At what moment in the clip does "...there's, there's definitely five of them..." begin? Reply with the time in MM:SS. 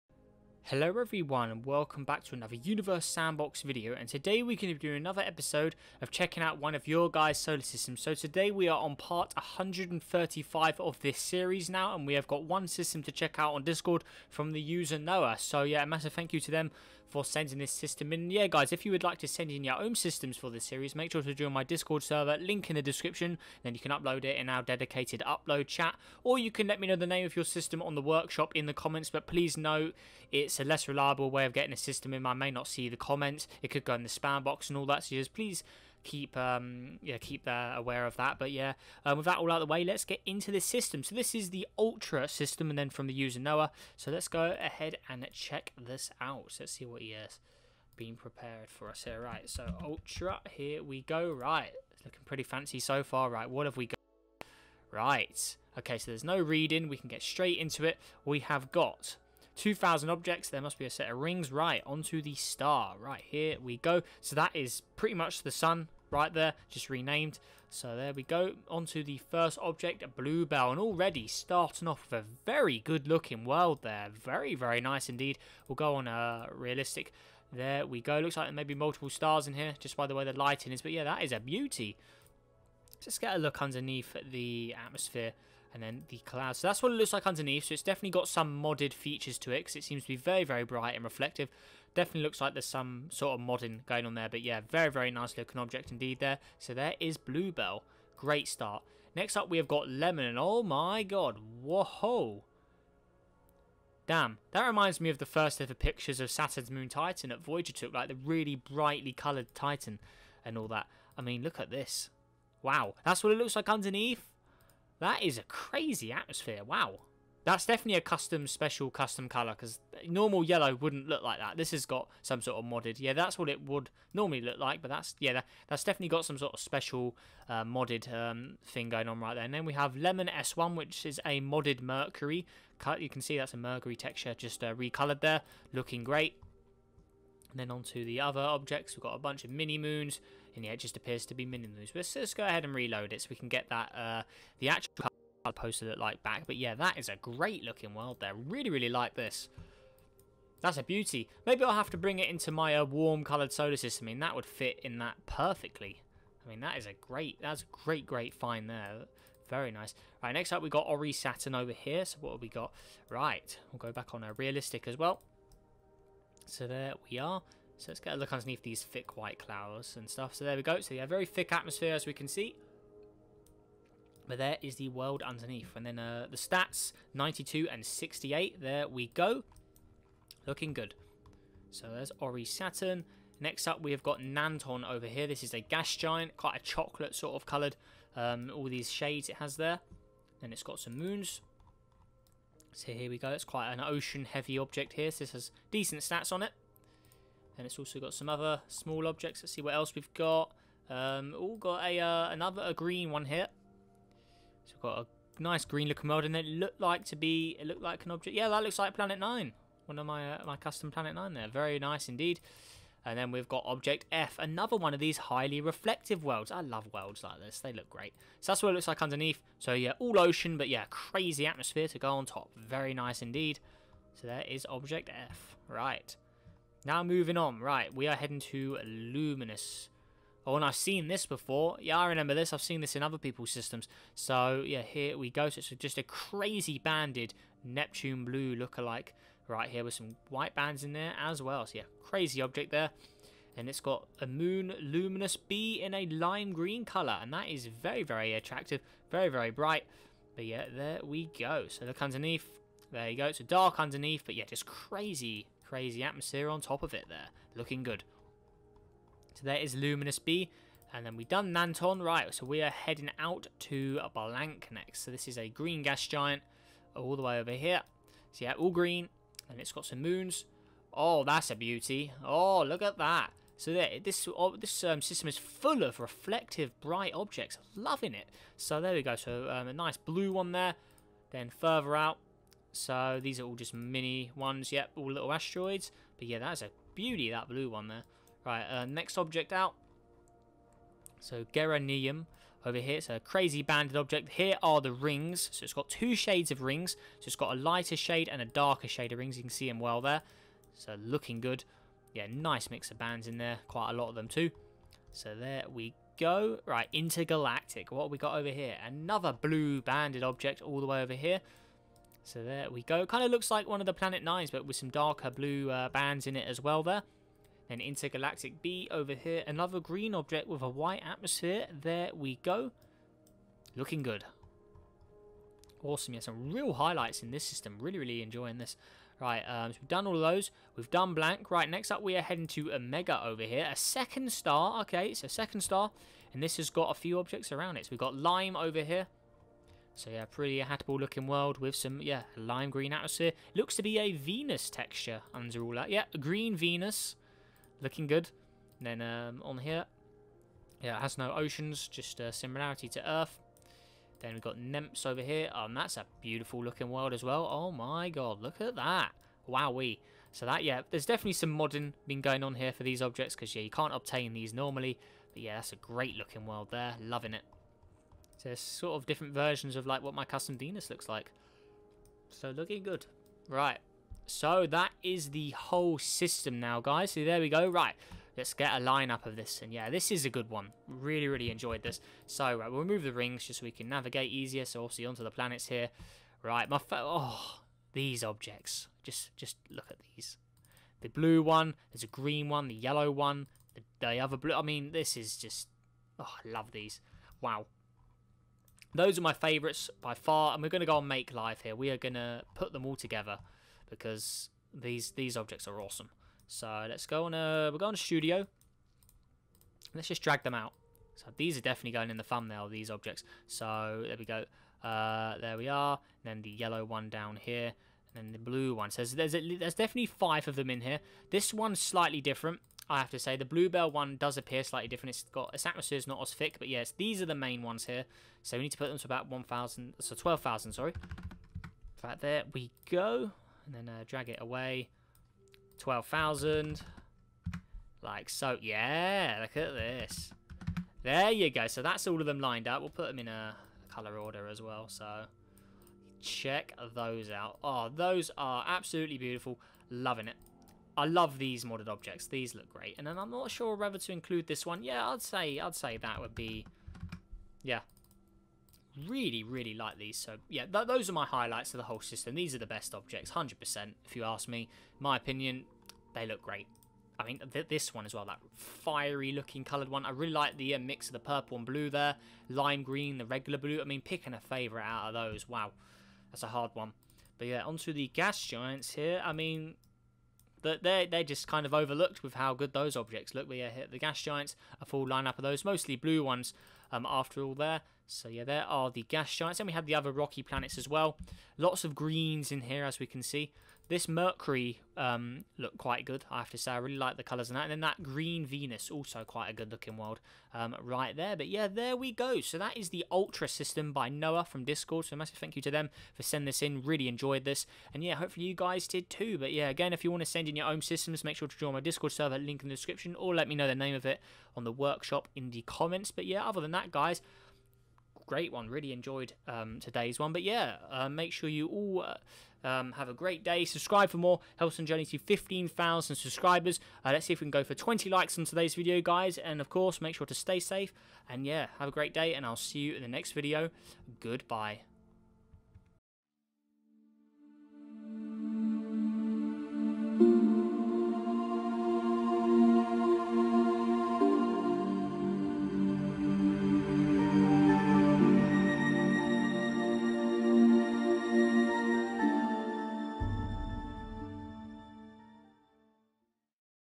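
06:59.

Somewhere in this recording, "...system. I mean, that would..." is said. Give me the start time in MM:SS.
02:33.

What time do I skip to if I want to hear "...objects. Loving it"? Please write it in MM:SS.
04:37.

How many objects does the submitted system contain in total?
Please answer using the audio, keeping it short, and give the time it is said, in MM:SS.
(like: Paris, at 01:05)
2,000, at 00:59.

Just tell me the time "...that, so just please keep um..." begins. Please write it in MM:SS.
00:34.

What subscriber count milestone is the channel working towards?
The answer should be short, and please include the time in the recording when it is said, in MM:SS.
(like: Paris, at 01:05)
15,000, at 08:45.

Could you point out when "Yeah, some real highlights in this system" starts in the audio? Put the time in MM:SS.
05:26.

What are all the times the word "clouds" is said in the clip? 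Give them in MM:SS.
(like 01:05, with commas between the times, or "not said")
01:26, 02:49.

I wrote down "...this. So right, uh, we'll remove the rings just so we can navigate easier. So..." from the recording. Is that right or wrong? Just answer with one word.
right.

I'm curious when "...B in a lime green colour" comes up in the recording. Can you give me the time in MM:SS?
04:05.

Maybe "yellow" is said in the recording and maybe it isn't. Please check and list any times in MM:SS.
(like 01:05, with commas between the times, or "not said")
02:00, 06:32, 06:56.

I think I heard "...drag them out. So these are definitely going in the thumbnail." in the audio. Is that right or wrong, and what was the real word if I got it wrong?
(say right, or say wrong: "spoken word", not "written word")
right.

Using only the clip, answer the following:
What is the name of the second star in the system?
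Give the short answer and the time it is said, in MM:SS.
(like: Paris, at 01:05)
Omega, at 05:32.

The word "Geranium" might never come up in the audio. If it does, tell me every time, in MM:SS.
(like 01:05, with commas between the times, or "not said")
04:51.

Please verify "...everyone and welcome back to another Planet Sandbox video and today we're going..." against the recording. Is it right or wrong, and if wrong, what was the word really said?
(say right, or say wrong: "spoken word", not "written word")
wrong: "Universe", not "Planet".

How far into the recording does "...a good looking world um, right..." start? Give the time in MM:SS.
08:19.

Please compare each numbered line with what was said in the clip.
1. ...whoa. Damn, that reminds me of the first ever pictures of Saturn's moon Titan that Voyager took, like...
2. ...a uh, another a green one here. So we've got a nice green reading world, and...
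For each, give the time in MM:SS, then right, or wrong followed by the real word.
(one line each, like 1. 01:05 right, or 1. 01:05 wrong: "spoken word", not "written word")
1. 01:41 right
2. 03:21 wrong: "looking", not "reading".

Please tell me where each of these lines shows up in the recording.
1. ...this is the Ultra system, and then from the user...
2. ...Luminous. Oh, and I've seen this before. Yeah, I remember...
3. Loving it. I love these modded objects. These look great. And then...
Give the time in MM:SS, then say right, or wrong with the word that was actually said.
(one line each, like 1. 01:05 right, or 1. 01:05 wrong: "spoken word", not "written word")
1. 00:41 right
2. 03:48 right
3. 07:29 right.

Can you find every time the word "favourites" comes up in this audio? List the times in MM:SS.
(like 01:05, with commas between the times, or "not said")
06:39, 07:54.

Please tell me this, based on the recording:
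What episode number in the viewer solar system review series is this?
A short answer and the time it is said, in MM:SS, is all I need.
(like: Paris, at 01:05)
135, at 00:08.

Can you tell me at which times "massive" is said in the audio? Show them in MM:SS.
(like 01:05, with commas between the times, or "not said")
00:15, 08:25.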